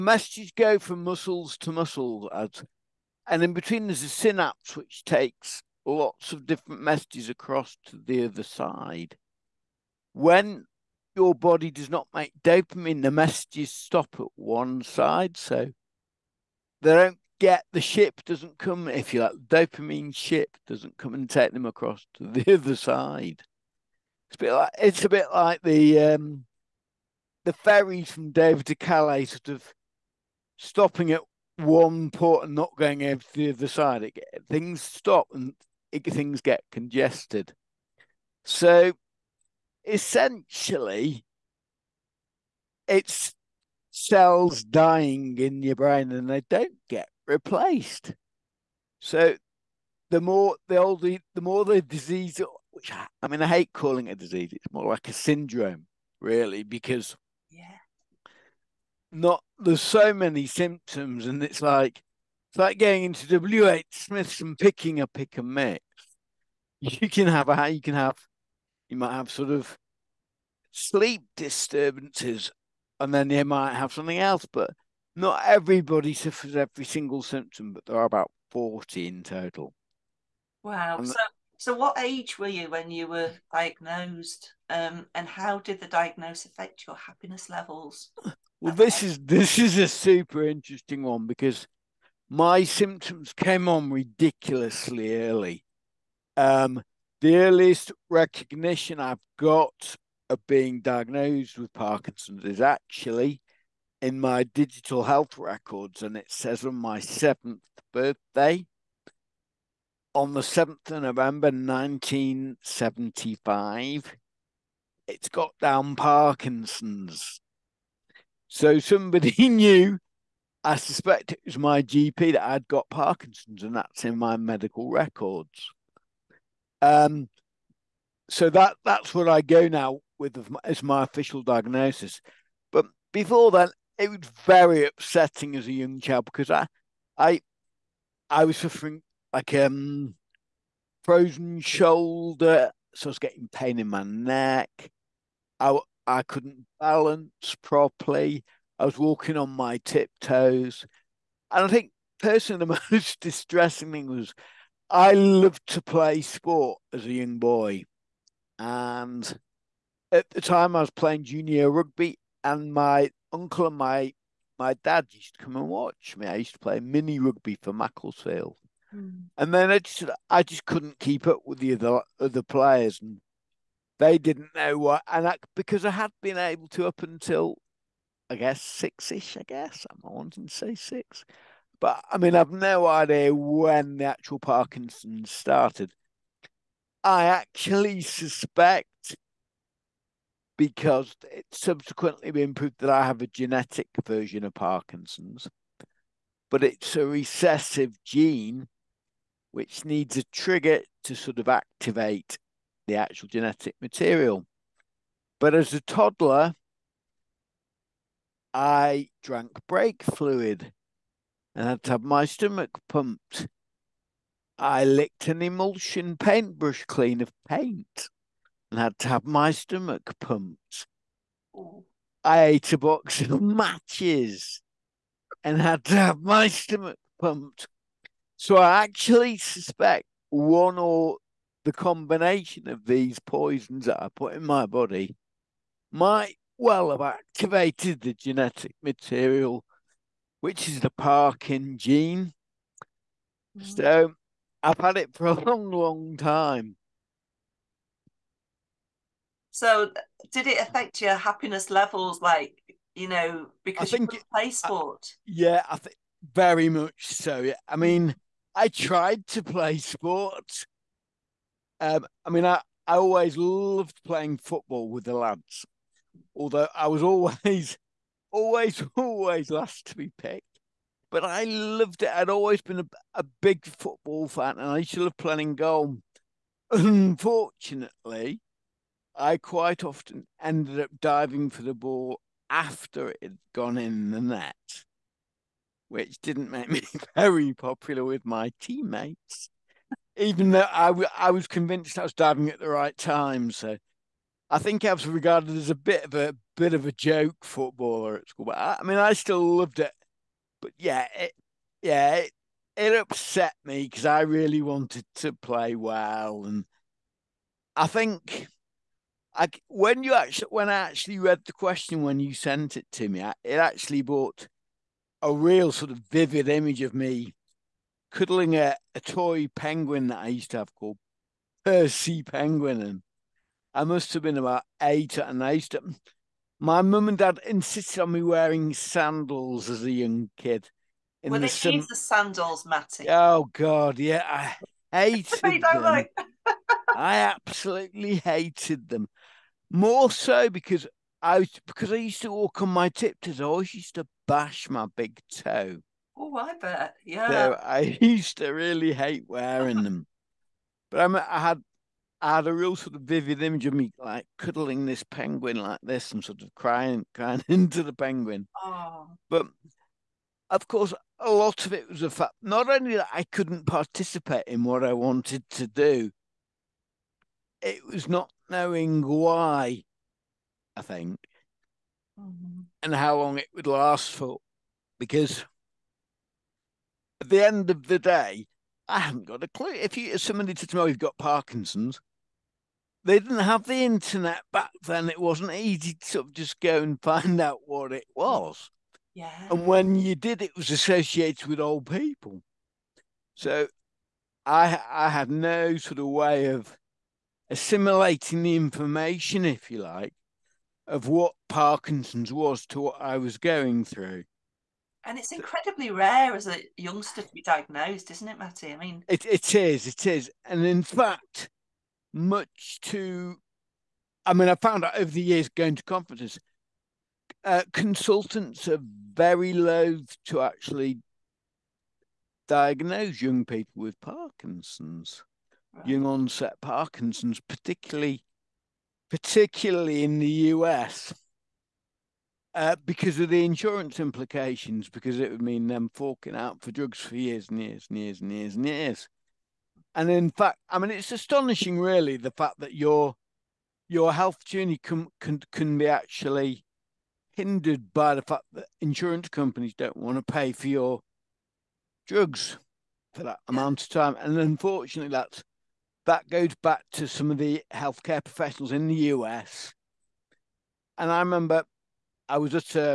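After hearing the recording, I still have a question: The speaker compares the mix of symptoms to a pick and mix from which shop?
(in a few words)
WH Smith's.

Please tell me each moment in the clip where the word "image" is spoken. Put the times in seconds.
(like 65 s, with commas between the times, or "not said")
316 s, 353 s.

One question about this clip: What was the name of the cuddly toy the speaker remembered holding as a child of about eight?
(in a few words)
Percy Penguin.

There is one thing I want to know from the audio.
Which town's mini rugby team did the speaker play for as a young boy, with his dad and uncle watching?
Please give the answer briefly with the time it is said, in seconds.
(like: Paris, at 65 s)
Macclesfield, at 167 s.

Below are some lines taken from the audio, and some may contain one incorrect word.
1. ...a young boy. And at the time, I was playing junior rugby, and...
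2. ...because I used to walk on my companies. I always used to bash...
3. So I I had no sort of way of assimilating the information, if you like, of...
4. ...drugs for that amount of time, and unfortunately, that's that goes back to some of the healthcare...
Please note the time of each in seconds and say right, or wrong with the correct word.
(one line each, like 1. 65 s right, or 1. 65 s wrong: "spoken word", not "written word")
1. 157 s right
2. 341 s wrong: "tiptoes", not "companies"
3. 393 s right
4. 452 s right.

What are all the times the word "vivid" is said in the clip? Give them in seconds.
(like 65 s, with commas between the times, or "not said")
316 s, 353 s.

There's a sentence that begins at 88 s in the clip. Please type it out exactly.
Well, this is this is a super interesting one because my symptoms came on ridiculously early.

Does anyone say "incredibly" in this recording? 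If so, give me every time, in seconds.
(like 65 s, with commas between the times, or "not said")
405 s.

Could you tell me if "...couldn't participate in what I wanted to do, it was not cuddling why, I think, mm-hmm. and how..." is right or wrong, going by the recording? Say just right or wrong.
wrong.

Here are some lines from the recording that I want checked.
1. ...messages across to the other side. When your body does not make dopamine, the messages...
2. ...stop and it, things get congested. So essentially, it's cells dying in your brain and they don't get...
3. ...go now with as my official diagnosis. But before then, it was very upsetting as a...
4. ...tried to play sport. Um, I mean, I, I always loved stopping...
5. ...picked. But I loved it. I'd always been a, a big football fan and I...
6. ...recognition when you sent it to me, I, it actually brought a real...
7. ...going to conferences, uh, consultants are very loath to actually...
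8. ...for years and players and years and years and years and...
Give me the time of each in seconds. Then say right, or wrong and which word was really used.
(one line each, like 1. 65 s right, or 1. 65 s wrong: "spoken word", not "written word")
1. 6 s right
2. 34 s right
3. 129 s right
4. 258 s wrong: "playing", not "stopping"
5. 270 s right
6. 311 s wrong: "question", not "recognition"
7. 415 s right
8. 436 s wrong: "years", not "players".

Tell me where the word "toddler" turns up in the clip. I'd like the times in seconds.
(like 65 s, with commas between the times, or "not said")
205 s.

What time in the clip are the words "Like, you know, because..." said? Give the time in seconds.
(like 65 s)
252 s.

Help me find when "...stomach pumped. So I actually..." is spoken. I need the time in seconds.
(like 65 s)
226 s.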